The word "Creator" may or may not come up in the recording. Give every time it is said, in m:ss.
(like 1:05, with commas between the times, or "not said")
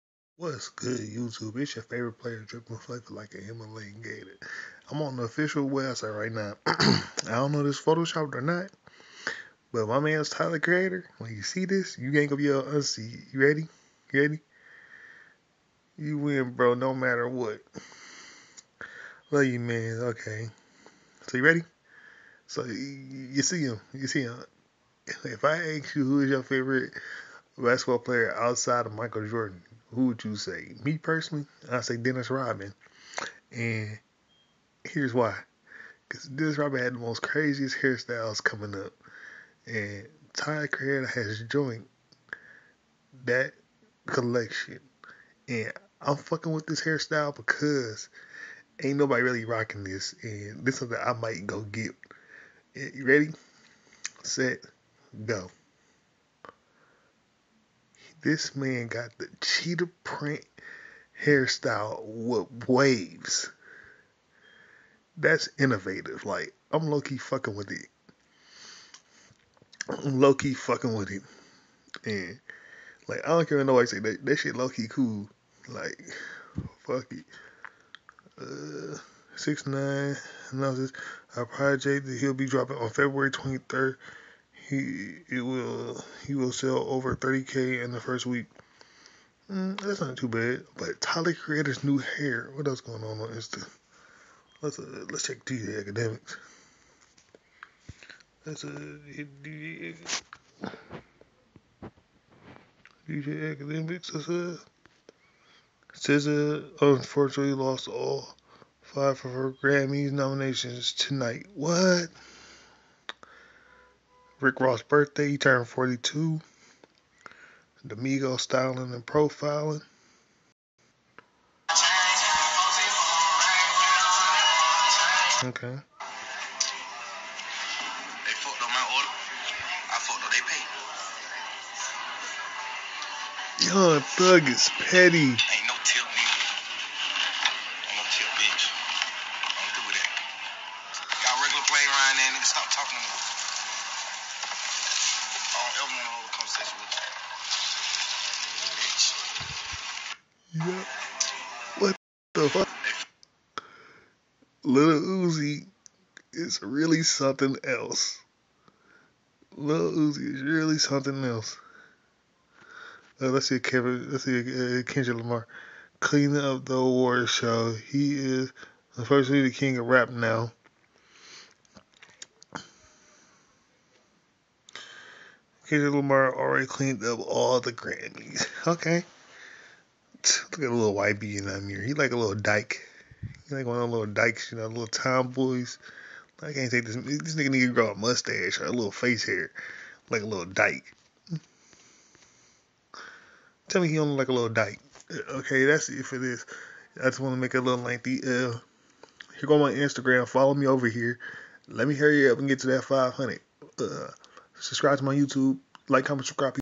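0:10, 1:31.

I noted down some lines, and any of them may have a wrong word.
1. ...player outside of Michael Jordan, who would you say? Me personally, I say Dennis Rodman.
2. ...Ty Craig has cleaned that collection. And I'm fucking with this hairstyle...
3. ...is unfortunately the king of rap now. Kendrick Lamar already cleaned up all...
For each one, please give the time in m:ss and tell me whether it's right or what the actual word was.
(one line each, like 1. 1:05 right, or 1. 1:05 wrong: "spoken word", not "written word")
1. 0:27 right
2. 0:40 wrong: "joined", not "cleaned"
3. 2:48 right.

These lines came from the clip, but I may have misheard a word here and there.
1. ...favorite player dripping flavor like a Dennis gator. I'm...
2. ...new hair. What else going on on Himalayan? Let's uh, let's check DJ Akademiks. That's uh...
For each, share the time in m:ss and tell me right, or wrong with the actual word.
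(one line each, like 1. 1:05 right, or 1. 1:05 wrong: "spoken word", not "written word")
1. 0:01 wrong: "Himalayan", not "Dennis"
2. 1:31 wrong: "Insta", not "Himalayan".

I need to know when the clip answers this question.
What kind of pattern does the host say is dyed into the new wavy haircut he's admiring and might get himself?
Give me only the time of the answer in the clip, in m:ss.
0:59.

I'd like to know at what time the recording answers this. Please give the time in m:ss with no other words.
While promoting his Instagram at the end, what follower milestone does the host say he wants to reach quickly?
3:22.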